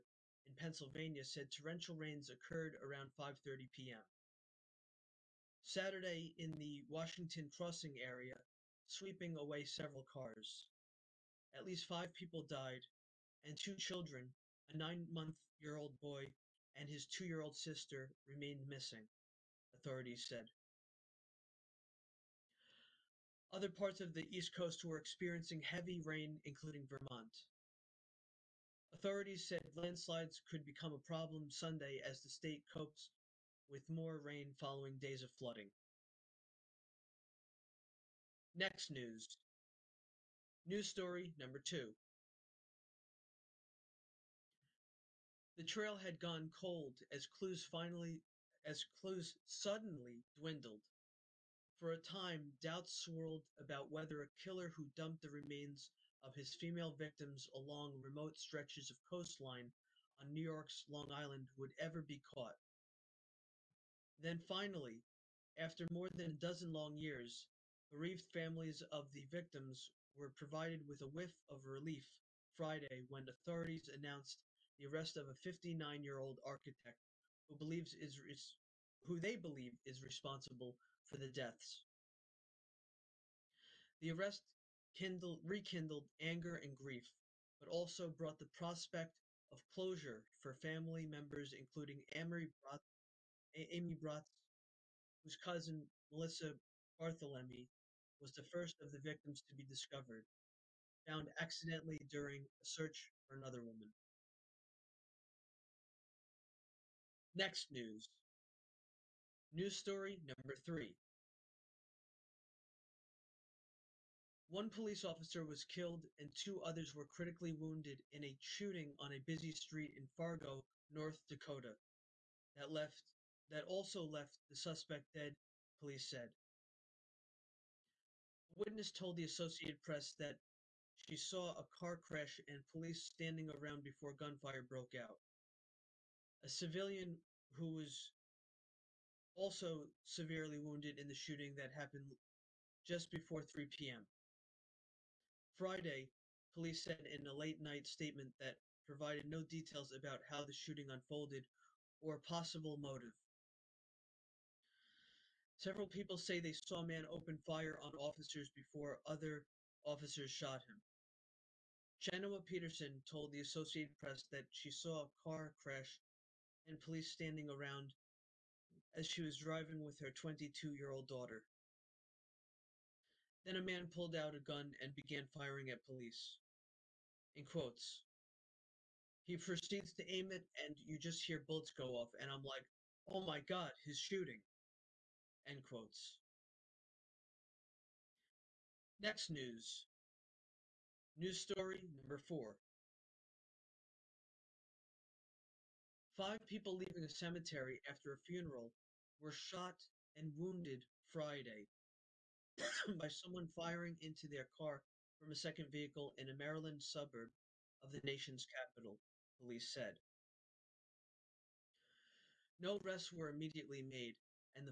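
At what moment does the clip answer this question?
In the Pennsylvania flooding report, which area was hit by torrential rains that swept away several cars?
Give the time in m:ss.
0:06.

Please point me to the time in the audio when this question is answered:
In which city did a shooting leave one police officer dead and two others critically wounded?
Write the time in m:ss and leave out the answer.
2:00.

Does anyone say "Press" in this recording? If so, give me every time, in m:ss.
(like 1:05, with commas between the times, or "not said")
2:09, 2:43.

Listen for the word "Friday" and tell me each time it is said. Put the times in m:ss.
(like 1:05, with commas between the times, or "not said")
1:12, 2:25, 3:21.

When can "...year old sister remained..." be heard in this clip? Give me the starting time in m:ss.
0:17.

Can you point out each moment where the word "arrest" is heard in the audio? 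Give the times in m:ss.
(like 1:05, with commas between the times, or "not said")
1:14, 1:24, 3:32.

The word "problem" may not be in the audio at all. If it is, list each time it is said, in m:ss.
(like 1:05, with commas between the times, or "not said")
0:30.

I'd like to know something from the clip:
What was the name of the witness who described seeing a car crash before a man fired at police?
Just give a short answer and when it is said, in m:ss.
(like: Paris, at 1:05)
Genoa Peterson, at 2:41.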